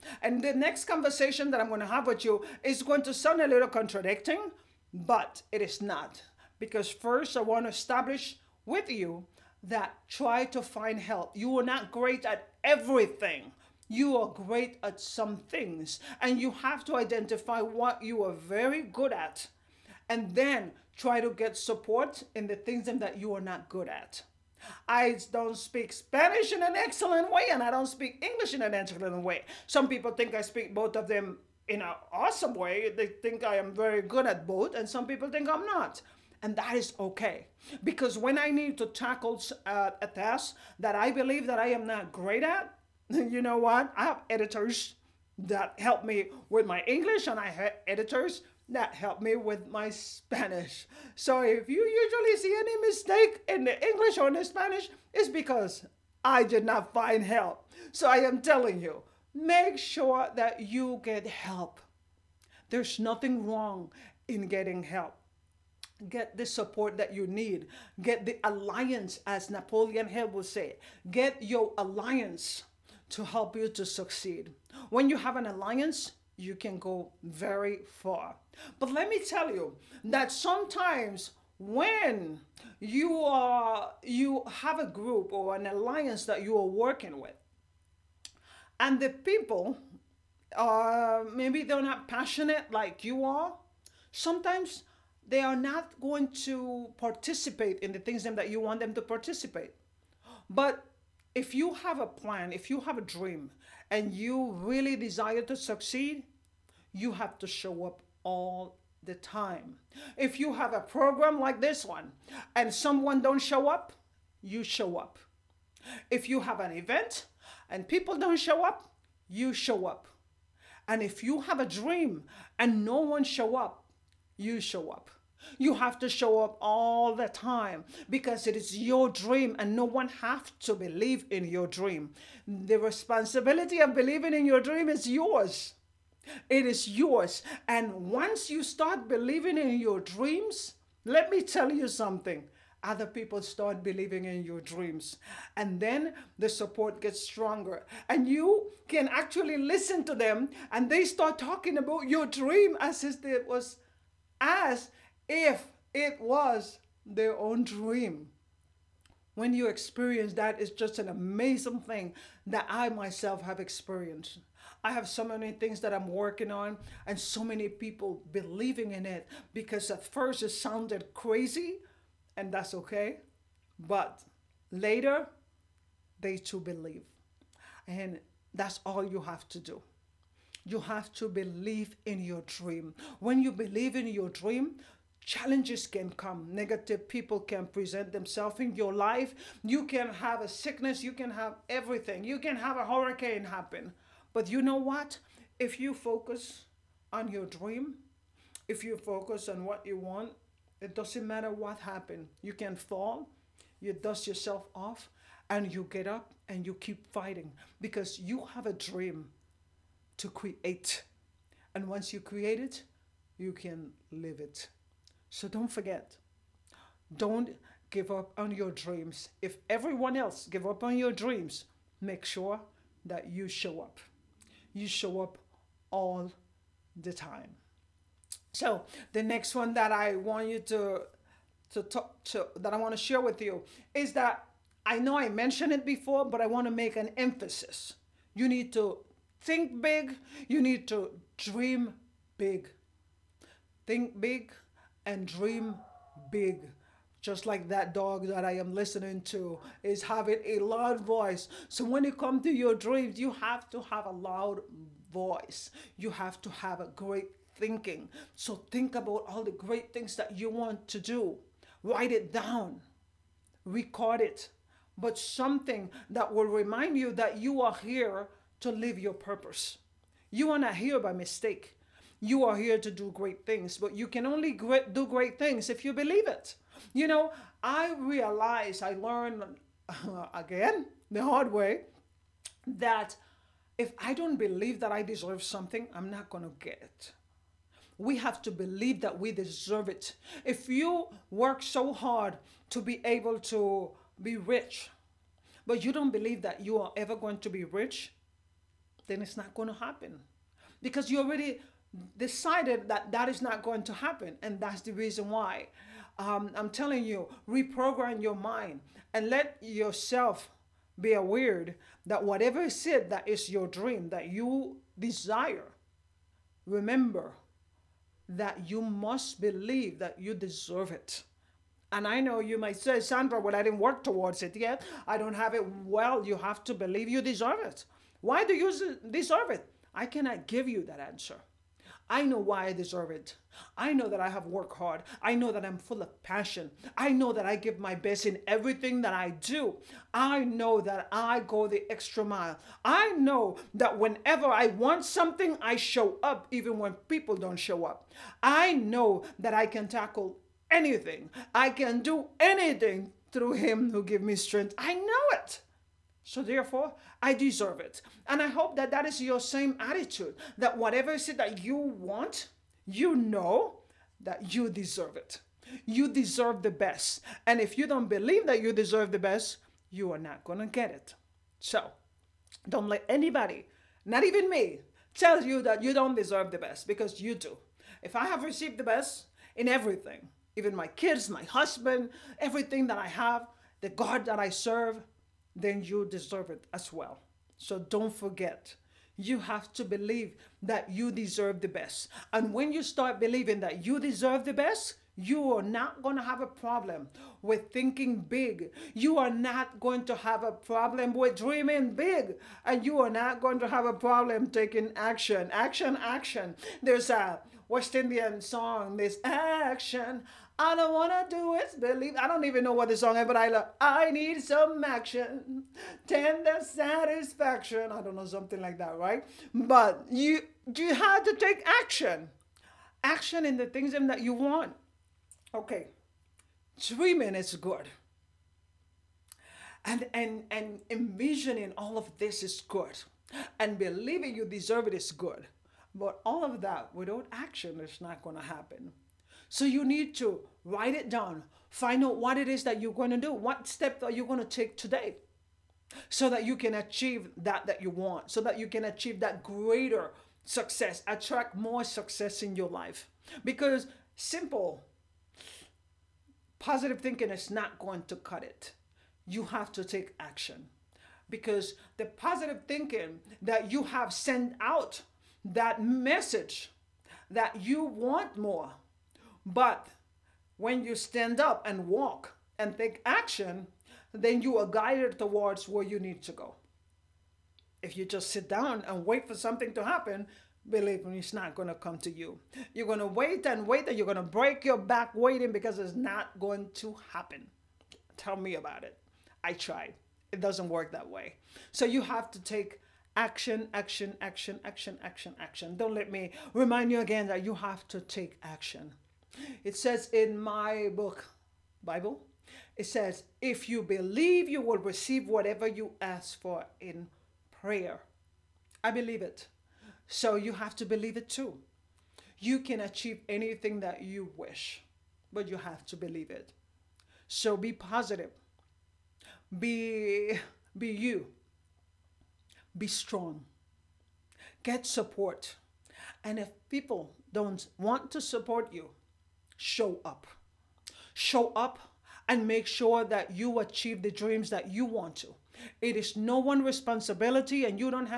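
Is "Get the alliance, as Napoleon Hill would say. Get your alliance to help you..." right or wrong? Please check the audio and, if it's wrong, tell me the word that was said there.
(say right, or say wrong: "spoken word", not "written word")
right.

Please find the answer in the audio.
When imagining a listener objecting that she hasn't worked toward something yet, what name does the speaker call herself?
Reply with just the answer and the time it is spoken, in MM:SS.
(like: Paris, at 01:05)
Sandra, at 05:22.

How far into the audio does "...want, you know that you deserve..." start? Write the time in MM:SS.
06:01.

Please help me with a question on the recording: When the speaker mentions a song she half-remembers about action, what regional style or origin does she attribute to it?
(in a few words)
West Indian.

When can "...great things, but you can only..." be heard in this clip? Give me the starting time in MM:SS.
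04:33.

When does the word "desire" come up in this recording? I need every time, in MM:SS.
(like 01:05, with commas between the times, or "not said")
01:44, 05:14.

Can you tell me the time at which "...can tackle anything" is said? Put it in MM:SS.
05:49.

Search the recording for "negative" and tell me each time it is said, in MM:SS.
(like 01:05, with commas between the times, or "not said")
03:06.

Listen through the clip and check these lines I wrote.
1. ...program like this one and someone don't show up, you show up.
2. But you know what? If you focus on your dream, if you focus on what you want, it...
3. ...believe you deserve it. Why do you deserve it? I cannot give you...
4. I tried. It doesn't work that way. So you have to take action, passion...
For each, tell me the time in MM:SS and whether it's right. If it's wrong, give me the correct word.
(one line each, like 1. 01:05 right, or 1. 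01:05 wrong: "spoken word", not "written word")
1. 01:50 right
2. 03:14 right
3. 05:26 right
4. 08:09 wrong: "action", not "passion".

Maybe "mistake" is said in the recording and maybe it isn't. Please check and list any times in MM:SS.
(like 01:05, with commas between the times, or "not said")
00:52, 04:31.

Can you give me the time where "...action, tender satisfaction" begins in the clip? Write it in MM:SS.
06:54.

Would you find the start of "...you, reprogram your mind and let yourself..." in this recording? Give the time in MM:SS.
05:07.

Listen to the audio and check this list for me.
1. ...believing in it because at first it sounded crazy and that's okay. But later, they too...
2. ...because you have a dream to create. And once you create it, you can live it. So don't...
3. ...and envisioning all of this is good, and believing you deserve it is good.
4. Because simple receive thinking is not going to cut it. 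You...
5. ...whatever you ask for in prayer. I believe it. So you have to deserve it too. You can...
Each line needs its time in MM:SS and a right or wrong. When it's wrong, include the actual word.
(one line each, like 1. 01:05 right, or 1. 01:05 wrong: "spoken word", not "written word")
1. 02:48 right
2. 03:27 right
3. 07:10 right
4. 07:33 wrong: "positive", not "receive"
5. 08:25 wrong: "believe", not "deserve".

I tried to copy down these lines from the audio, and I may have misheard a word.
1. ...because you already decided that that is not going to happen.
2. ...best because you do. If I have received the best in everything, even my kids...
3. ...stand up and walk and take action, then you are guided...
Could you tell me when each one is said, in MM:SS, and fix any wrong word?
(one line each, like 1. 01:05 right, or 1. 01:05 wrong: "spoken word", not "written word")
1. 05:00 right
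2. 06:16 right
3. 07:50 right.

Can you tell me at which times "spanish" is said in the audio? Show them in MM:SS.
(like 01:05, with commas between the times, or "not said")
00:25, 00:49, 00:54.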